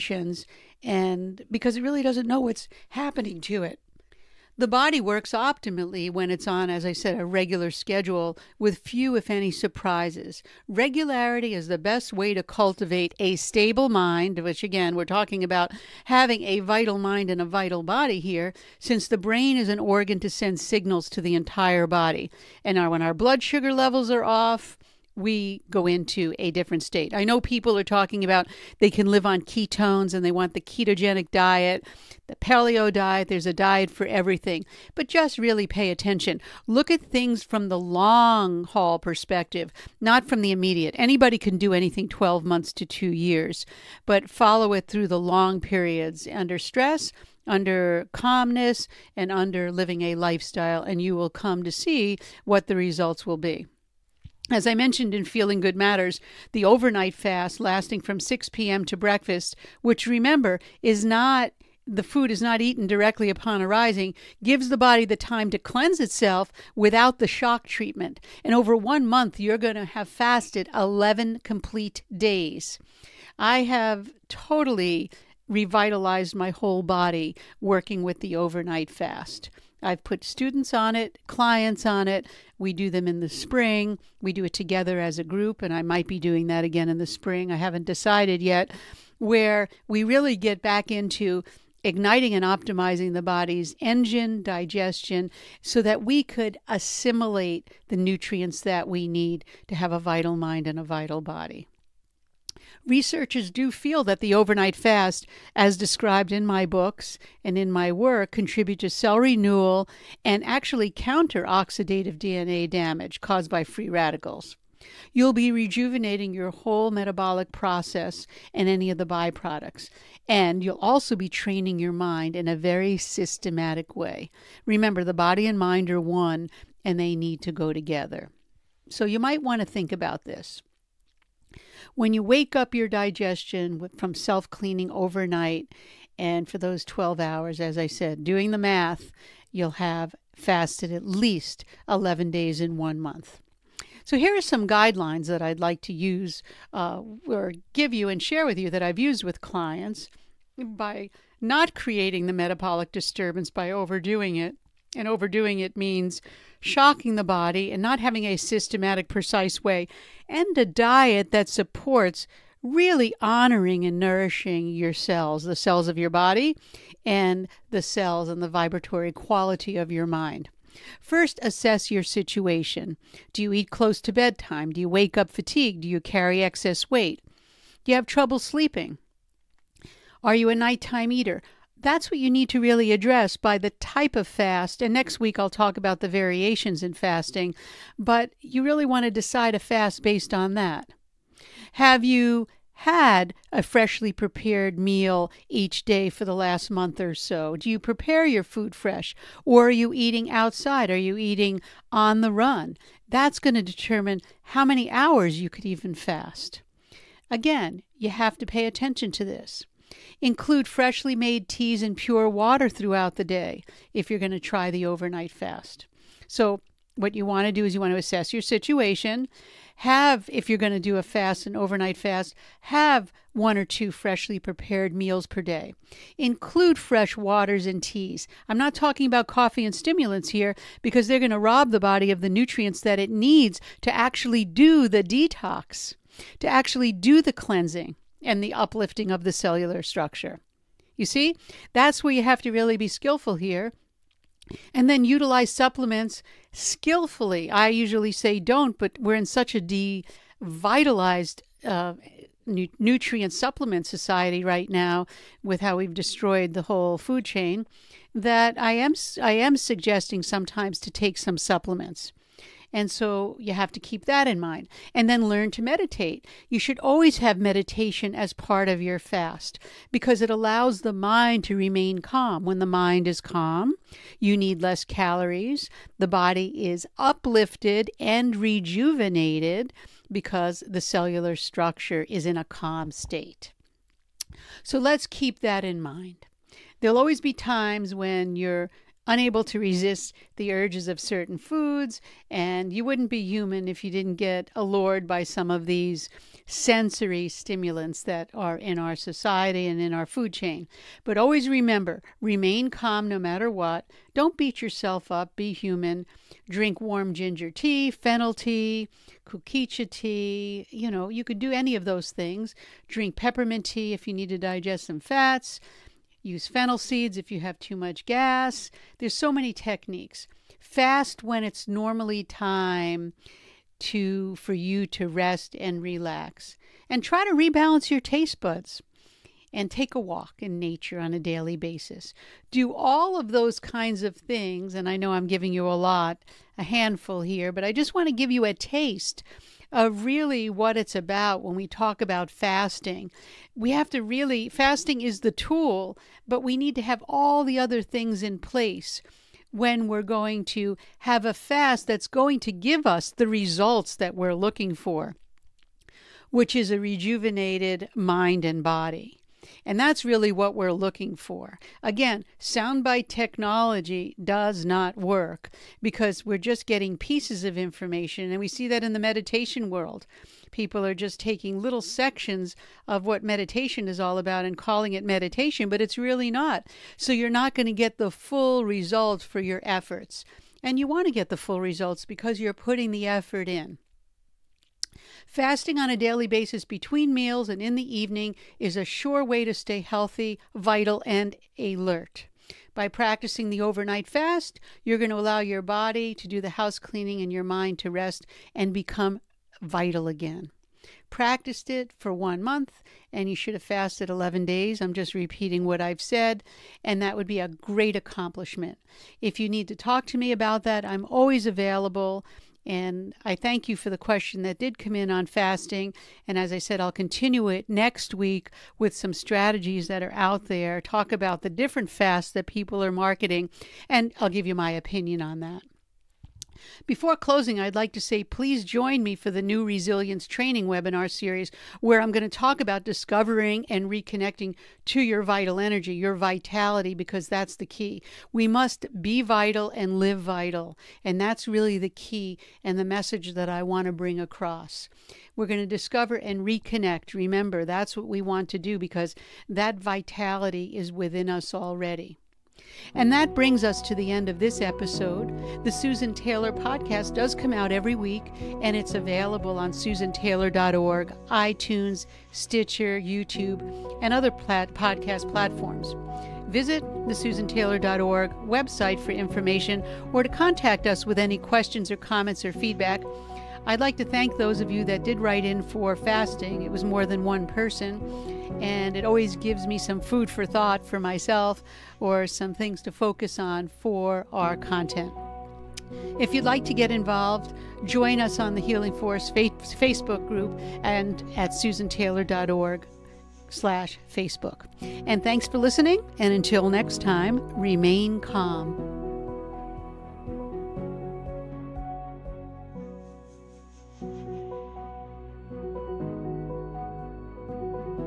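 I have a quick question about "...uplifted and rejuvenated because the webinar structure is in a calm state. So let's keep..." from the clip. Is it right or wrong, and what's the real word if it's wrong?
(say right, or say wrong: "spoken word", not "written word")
wrong: "cellular", not "webinar".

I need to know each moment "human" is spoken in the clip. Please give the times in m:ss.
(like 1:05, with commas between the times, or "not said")
4:53, 5:05.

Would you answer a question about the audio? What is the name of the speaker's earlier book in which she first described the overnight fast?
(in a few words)
Feeling Good Matters.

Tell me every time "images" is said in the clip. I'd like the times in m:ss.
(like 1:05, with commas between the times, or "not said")
not said.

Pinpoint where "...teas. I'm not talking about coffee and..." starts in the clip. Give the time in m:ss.
3:47.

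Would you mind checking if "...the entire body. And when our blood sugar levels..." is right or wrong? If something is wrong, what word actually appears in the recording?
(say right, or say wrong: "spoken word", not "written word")
right.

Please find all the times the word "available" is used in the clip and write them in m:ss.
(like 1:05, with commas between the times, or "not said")
6:51, 7:38.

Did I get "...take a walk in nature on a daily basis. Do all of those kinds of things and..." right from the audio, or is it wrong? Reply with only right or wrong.
right.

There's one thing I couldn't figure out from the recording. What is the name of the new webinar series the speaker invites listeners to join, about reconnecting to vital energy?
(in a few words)
Resilience training.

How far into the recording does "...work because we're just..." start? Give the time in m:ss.
6:04.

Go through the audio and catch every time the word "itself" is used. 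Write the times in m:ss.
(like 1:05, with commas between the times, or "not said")
1:06.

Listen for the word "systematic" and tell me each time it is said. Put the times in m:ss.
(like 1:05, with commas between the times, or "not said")
2:02, 2:38.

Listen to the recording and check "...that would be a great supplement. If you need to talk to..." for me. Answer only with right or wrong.
wrong.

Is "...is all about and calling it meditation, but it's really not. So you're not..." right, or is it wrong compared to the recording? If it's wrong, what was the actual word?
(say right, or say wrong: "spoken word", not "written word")
right.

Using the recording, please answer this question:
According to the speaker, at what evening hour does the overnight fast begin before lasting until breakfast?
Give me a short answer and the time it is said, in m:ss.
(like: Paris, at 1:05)
6 p.m., at 0:58.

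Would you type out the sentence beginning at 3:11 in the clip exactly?
Have you had a freshly prepared meal each day for the last month or so?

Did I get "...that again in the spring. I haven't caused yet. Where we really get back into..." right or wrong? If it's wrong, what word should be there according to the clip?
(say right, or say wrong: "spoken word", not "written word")
wrong: "decided", not "caused".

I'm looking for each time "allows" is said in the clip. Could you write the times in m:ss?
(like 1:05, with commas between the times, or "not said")
4:30, 6:35.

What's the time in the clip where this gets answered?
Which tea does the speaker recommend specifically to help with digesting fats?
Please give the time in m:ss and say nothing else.
5:13.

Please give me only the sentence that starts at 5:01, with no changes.
But always remember remain calm no matter what.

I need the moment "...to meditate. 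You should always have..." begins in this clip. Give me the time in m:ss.
4:25.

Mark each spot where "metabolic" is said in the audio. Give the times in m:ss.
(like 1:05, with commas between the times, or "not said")
1:56, 2:32.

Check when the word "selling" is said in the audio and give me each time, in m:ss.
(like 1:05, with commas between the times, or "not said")
not said.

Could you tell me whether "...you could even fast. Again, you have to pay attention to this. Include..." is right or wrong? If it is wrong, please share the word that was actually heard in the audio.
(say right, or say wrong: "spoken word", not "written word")
right.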